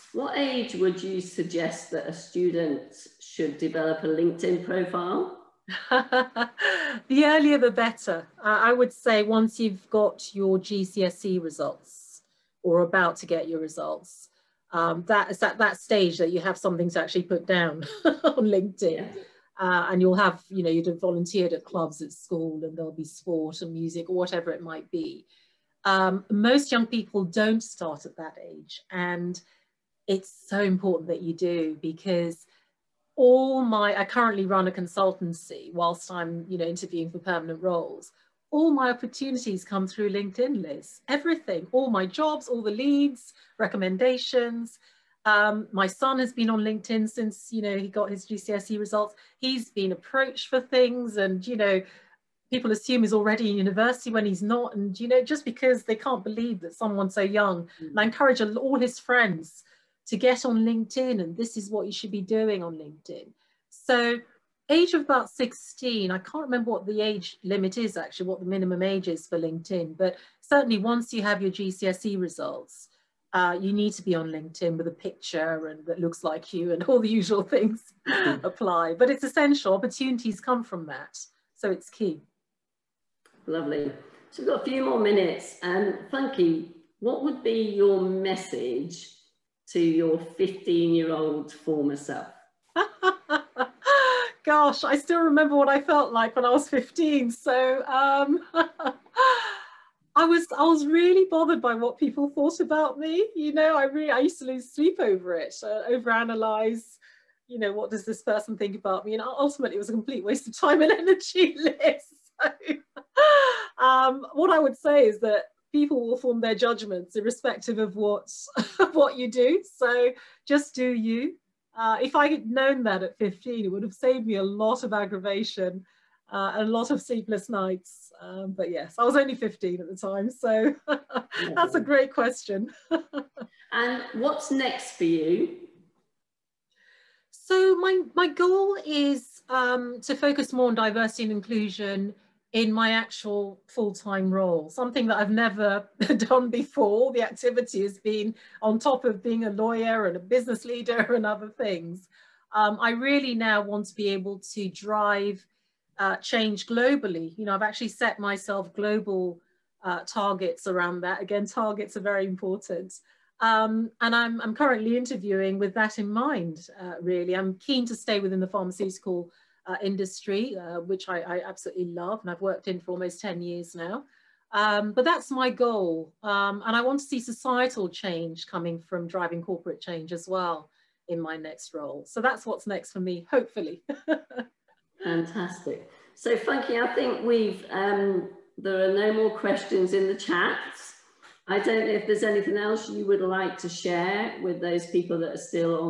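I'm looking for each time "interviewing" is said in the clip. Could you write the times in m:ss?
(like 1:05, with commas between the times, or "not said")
0:36, 2:44.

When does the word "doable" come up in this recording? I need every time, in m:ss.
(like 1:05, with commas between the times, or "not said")
not said.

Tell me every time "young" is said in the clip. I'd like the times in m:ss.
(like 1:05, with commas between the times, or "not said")
0:26, 0:57.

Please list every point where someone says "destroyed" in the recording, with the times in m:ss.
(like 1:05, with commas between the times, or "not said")
not said.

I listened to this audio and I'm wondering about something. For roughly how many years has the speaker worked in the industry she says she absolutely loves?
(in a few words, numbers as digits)
Almost 10 years.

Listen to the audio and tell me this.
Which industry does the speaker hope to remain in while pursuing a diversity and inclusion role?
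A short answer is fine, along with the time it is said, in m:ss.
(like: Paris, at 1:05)
Pharmaceutical, at 2:48.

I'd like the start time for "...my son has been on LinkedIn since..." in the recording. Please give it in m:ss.
0:45.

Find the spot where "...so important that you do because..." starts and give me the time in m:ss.
0:30.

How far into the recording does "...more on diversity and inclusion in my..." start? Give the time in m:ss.
2:20.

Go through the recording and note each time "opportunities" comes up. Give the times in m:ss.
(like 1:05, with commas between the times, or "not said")
0:38, 1:19.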